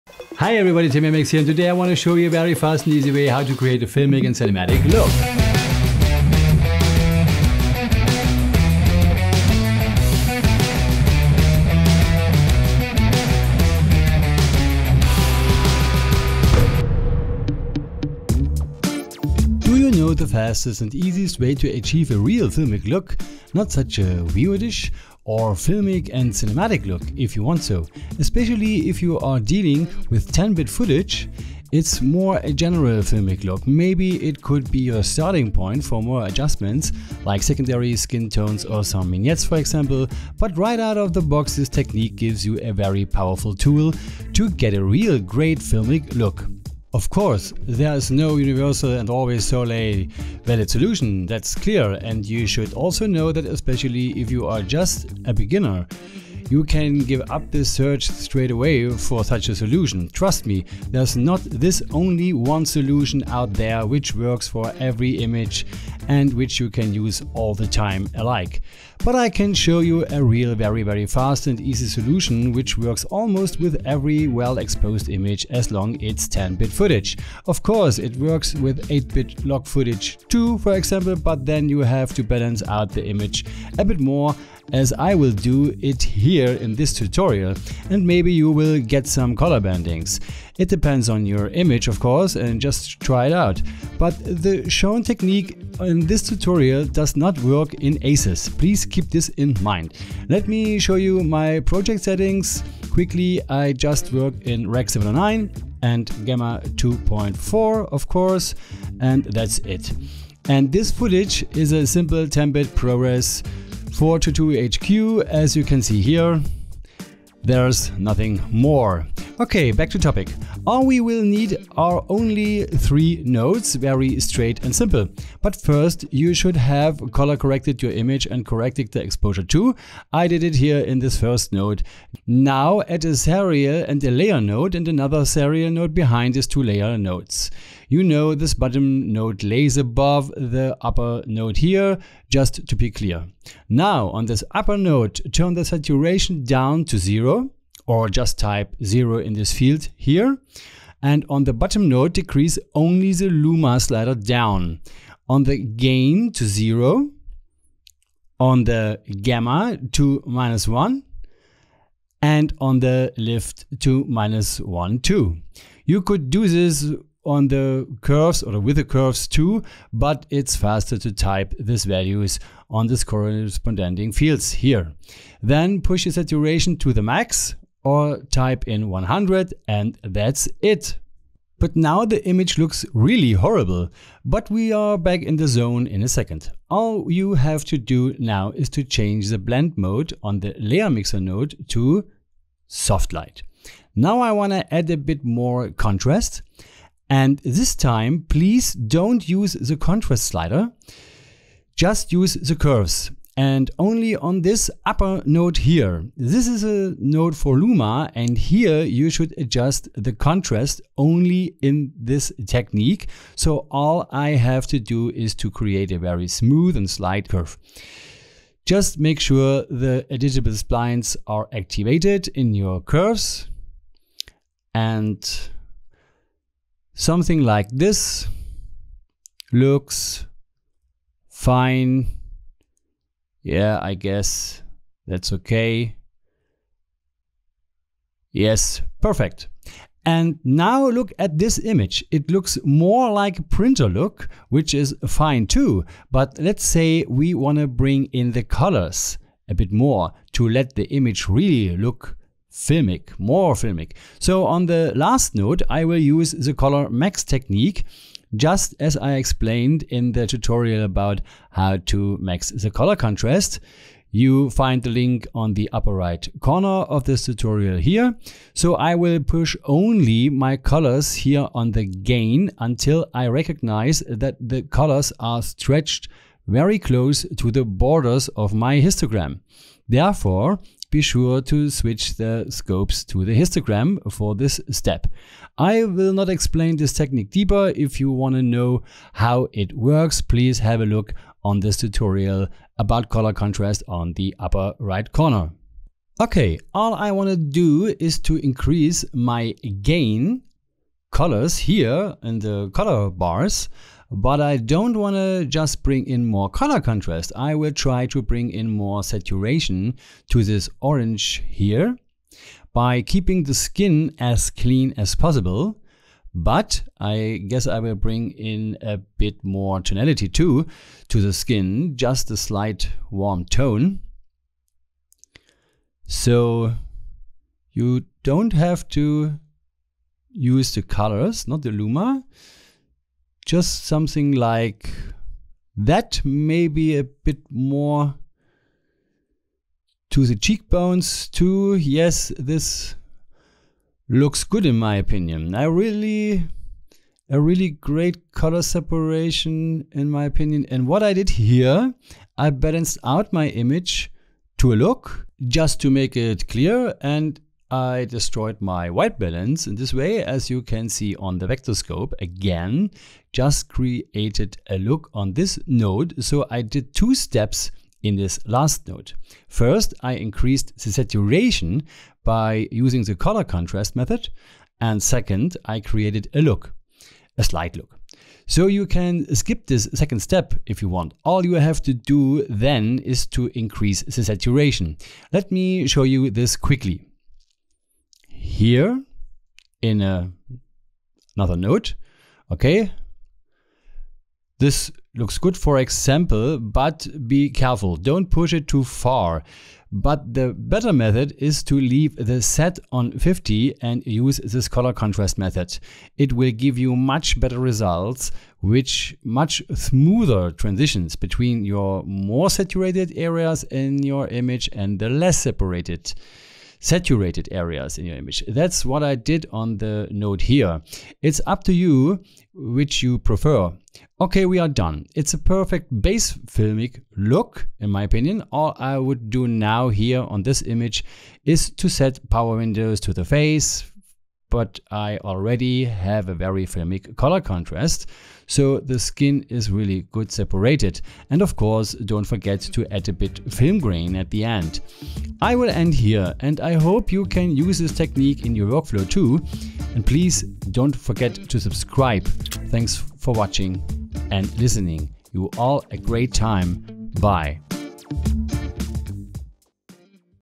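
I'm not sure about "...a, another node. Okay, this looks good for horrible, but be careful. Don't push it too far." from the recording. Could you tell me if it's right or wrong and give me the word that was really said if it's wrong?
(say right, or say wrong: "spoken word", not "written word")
wrong: "example", not "horrible".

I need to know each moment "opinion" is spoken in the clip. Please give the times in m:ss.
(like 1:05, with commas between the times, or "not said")
5:44, 5:50, 7:08.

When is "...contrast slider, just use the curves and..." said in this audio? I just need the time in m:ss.
3:19.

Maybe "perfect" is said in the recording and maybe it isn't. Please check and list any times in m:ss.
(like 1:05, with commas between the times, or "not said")
3:59, 7:05.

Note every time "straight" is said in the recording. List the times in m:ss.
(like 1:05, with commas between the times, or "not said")
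0:58, 2:04.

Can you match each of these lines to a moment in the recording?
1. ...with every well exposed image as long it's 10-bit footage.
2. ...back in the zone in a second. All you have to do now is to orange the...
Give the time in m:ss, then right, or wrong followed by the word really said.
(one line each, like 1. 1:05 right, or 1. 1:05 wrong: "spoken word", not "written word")
1. 1:13 right
2. 3:04 wrong: "change", not "orange".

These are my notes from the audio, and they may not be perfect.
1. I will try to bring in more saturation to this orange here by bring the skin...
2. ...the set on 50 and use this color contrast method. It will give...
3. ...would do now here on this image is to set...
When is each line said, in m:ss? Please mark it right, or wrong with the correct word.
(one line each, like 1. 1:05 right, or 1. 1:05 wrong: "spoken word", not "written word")
1. 5:07 wrong: "keeping", not "bring"
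2. 6:42 right
3. 7:08 right.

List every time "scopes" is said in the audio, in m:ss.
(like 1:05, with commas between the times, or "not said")
4:42, 6:01.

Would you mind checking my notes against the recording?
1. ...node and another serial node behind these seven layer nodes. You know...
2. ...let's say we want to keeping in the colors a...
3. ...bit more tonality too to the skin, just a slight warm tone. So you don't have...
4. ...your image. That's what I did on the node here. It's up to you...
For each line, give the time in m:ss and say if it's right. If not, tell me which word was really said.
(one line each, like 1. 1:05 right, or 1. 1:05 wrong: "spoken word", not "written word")
1. 2:14 wrong: "two", not "seven"
2. 4:06 wrong: "bring", not "keeping"
3. 5:18 right
4. 6:58 right.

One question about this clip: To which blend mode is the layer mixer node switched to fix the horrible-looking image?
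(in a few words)
Soft light.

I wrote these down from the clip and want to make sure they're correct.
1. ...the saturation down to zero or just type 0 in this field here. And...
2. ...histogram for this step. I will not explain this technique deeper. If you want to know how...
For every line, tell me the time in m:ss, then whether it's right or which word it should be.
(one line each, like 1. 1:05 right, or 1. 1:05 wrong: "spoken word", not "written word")
1. 2:25 right
2. 4:43 right.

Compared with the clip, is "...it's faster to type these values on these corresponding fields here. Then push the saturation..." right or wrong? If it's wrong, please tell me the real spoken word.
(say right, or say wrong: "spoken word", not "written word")
right.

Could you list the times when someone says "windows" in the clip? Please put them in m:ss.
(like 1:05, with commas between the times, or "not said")
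7:12.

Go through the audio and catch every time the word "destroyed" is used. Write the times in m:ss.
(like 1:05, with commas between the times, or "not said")
5:58.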